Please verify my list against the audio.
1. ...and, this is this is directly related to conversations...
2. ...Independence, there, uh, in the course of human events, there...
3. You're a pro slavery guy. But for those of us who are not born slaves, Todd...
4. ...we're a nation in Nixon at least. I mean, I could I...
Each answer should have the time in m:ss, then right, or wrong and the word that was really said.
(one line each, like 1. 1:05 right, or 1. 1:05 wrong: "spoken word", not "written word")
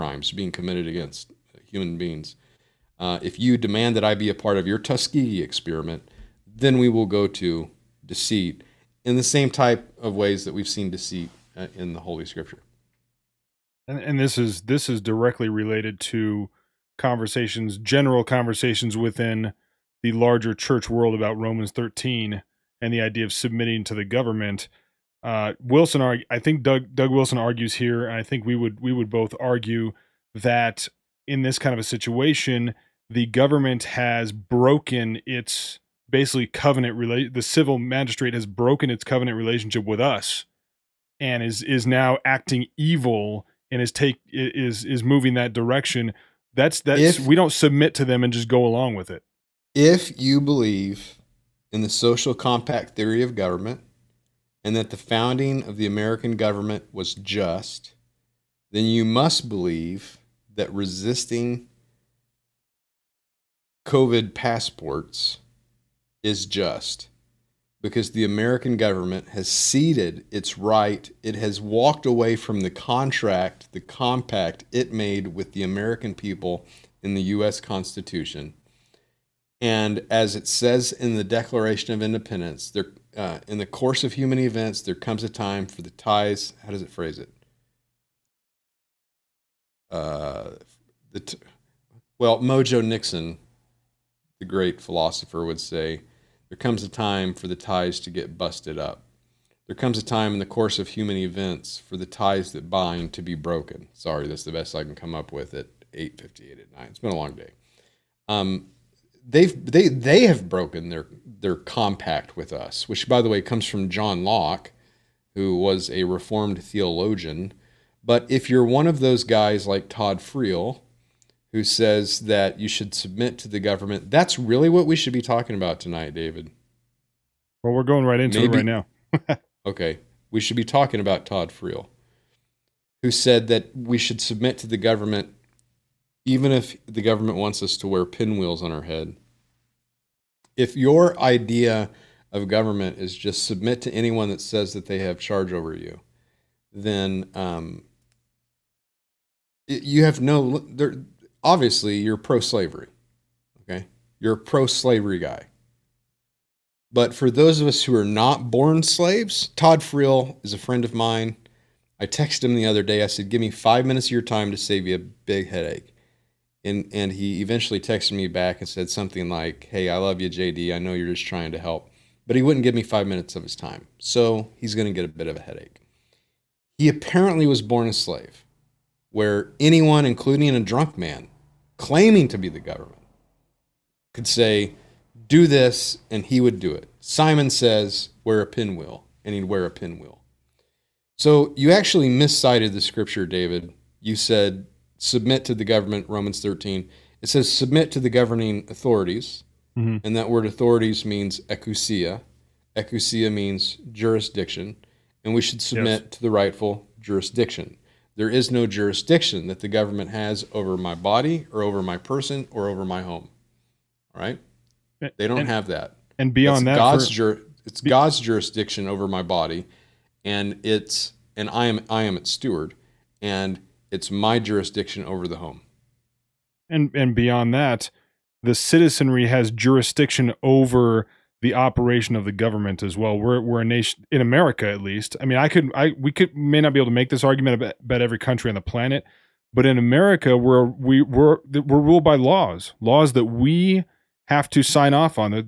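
1. 0:13 right
2. 1:22 right
3. 2:34 right
4. 3:53 wrong: "America", not "Nixon".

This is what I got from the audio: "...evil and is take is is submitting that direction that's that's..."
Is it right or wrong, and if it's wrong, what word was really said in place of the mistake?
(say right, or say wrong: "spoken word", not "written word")
wrong: "moving", not "submitting".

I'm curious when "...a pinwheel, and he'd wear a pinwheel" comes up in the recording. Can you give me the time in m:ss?
3:08.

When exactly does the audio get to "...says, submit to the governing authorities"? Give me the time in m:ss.
3:17.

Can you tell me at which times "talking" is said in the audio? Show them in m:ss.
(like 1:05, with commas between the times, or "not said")
2:05, 2:10.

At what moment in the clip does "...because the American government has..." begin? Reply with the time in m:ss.
1:07.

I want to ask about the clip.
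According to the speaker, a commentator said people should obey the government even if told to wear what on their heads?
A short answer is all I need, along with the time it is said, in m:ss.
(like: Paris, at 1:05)
Pinwheels, at 2:18.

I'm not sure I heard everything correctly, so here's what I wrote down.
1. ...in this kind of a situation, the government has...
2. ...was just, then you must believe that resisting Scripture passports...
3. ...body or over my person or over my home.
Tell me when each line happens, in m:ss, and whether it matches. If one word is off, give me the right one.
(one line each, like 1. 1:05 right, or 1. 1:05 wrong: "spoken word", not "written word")
1. 0:31 right
2. 0:56 wrong: "COVID", not "Scripture"
3. 3:30 right.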